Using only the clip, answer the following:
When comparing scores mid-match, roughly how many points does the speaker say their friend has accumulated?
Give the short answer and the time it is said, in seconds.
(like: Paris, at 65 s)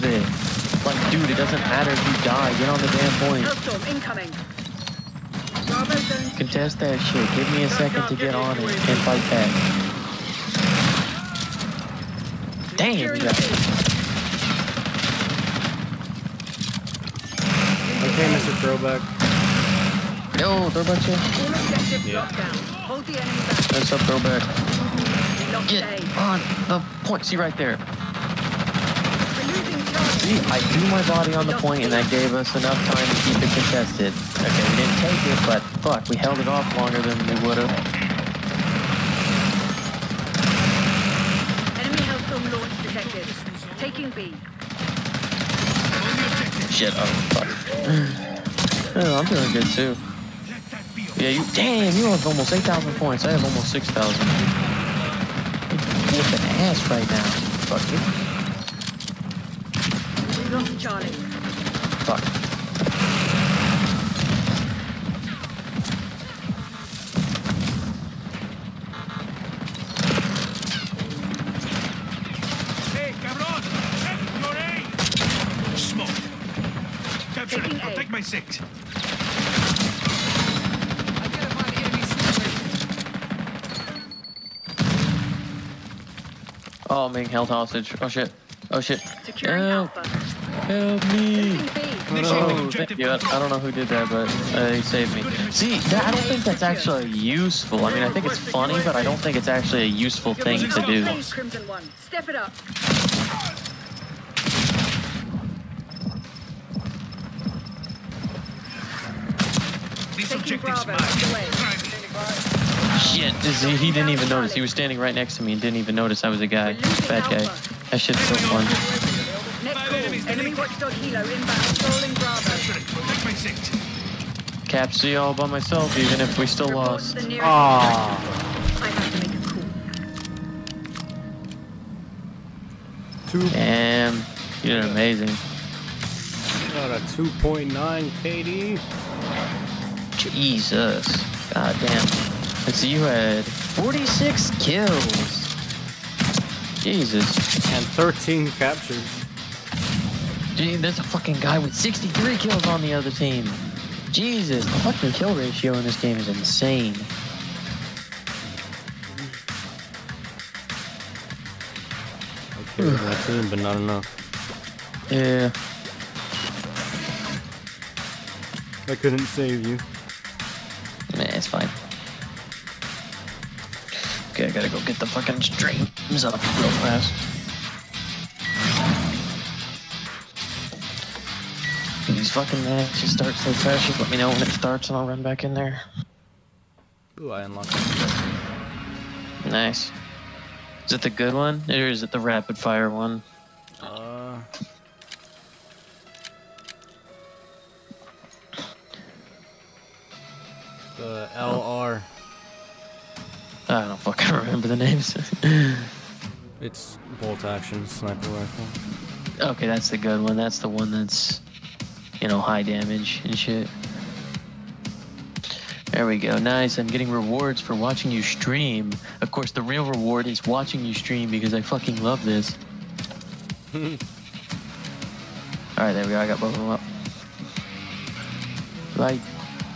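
8,000, at 52 s.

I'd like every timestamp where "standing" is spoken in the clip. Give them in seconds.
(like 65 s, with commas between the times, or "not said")
114 s.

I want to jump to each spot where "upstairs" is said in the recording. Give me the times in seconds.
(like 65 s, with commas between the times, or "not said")
not said.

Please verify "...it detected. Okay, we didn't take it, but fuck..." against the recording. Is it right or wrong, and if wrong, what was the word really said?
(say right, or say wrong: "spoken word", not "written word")
wrong: "contested", not "detected".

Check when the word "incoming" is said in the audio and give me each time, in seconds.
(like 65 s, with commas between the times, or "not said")
3 s.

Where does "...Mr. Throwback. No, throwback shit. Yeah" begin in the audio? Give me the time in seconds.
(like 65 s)
18 s.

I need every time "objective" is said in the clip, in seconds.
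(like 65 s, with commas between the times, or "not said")
110 s.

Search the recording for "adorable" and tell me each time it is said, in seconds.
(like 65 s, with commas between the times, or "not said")
not said.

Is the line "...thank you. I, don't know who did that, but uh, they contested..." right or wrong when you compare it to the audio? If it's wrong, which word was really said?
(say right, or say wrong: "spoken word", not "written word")
wrong: "saved", not "contested".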